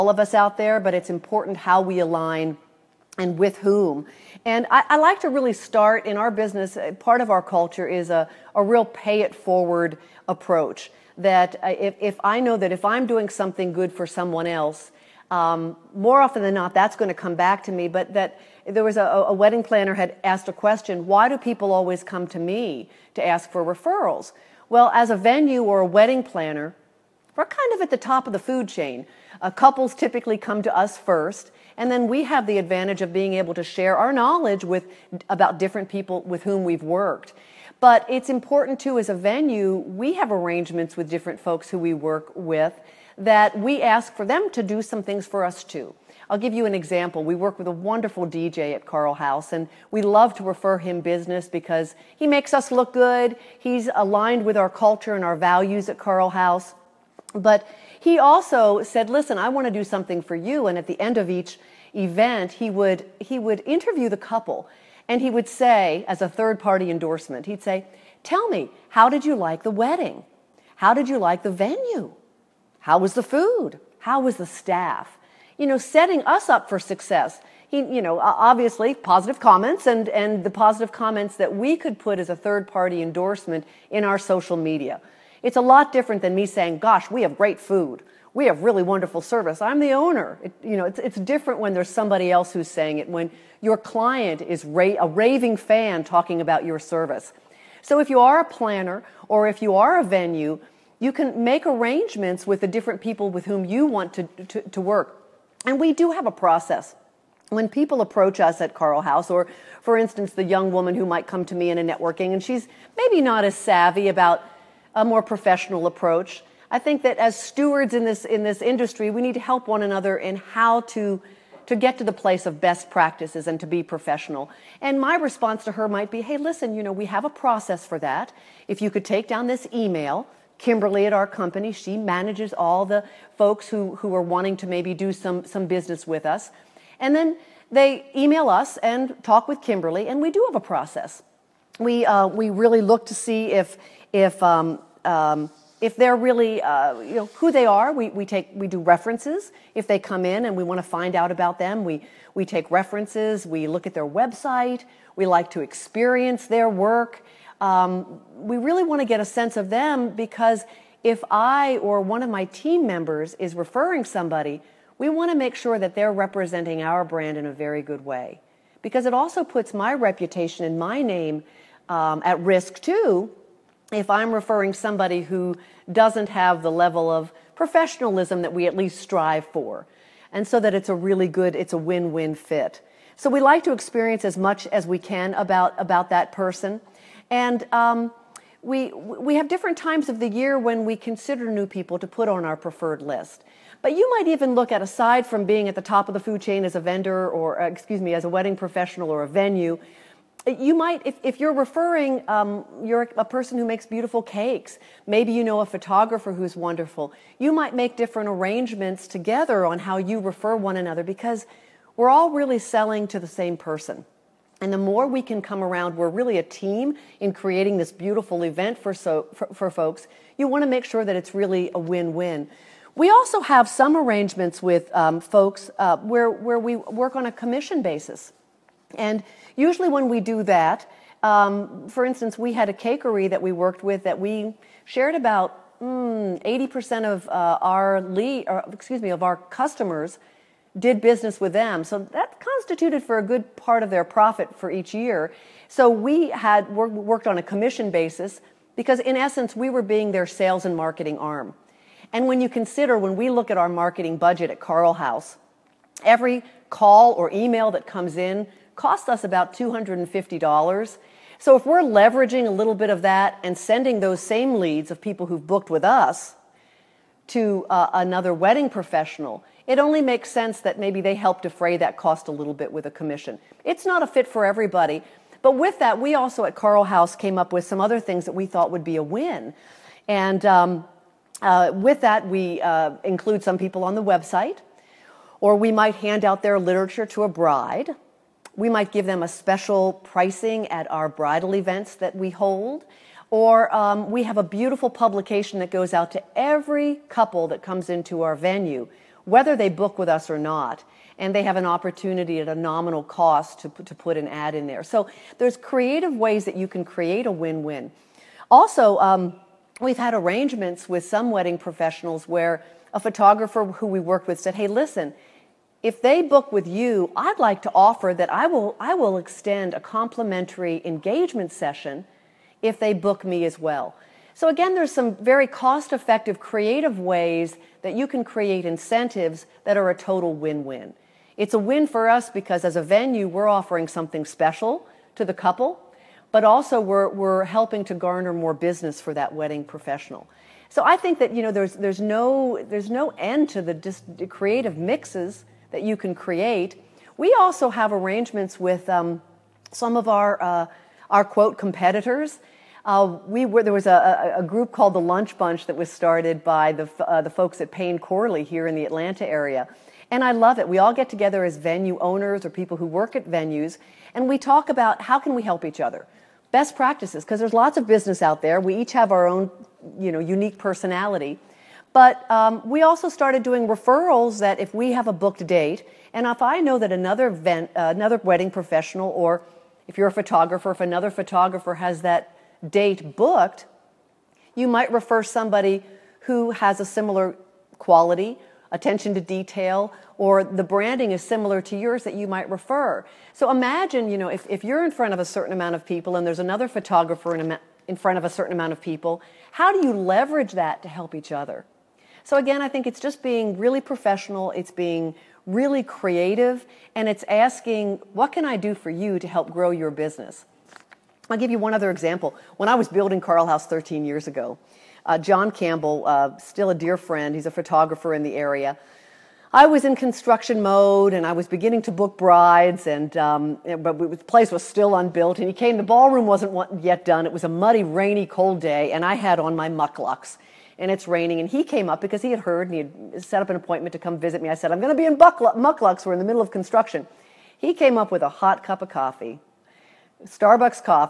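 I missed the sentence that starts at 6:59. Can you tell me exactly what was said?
I was in construction mode and I was beginning to book brides, and um, but the place was still unbuilt.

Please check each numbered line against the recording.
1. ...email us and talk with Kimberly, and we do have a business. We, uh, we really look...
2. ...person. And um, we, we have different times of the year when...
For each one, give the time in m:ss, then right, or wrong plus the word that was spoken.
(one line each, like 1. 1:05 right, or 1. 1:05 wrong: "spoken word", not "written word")
1. 2:18 wrong: "process", not "business"
2. 3:06 right.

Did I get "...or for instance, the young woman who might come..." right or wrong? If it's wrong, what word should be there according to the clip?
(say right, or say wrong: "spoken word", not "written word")
right.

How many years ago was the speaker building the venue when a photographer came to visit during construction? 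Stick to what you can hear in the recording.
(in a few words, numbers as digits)
13.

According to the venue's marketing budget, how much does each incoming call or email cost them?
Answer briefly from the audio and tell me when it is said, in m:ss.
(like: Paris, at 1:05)
$250, at 4:19.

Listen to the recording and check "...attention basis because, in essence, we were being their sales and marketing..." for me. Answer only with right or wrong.
wrong.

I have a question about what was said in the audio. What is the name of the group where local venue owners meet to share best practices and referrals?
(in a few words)
Lunch Bunch.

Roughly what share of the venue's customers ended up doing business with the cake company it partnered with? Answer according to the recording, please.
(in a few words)
80%.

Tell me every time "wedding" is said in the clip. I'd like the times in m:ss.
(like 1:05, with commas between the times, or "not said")
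0:19, 0:25, 1:09, 3:18, 4:28, 5:11, 5:39, 6:18.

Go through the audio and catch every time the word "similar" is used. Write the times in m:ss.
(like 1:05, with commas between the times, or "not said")
6:26, 6:31.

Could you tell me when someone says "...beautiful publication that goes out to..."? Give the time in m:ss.
4:54.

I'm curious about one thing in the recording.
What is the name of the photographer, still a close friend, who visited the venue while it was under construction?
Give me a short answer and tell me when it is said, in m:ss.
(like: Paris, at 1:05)
John Campbell, at 6:55.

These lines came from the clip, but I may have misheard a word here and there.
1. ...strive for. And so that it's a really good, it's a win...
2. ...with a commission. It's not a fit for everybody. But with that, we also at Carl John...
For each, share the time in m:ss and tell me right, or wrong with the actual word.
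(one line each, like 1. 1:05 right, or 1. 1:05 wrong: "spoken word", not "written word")
1. 2:58 right
2. 4:32 wrong: "House", not "John".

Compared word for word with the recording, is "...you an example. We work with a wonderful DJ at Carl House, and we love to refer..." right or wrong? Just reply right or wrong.
right.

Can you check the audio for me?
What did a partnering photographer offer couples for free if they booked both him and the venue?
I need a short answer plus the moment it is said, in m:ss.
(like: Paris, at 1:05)
Engagement session, at 5:20.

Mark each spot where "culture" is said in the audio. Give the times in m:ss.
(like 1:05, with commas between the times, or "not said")
0:07, 0:54.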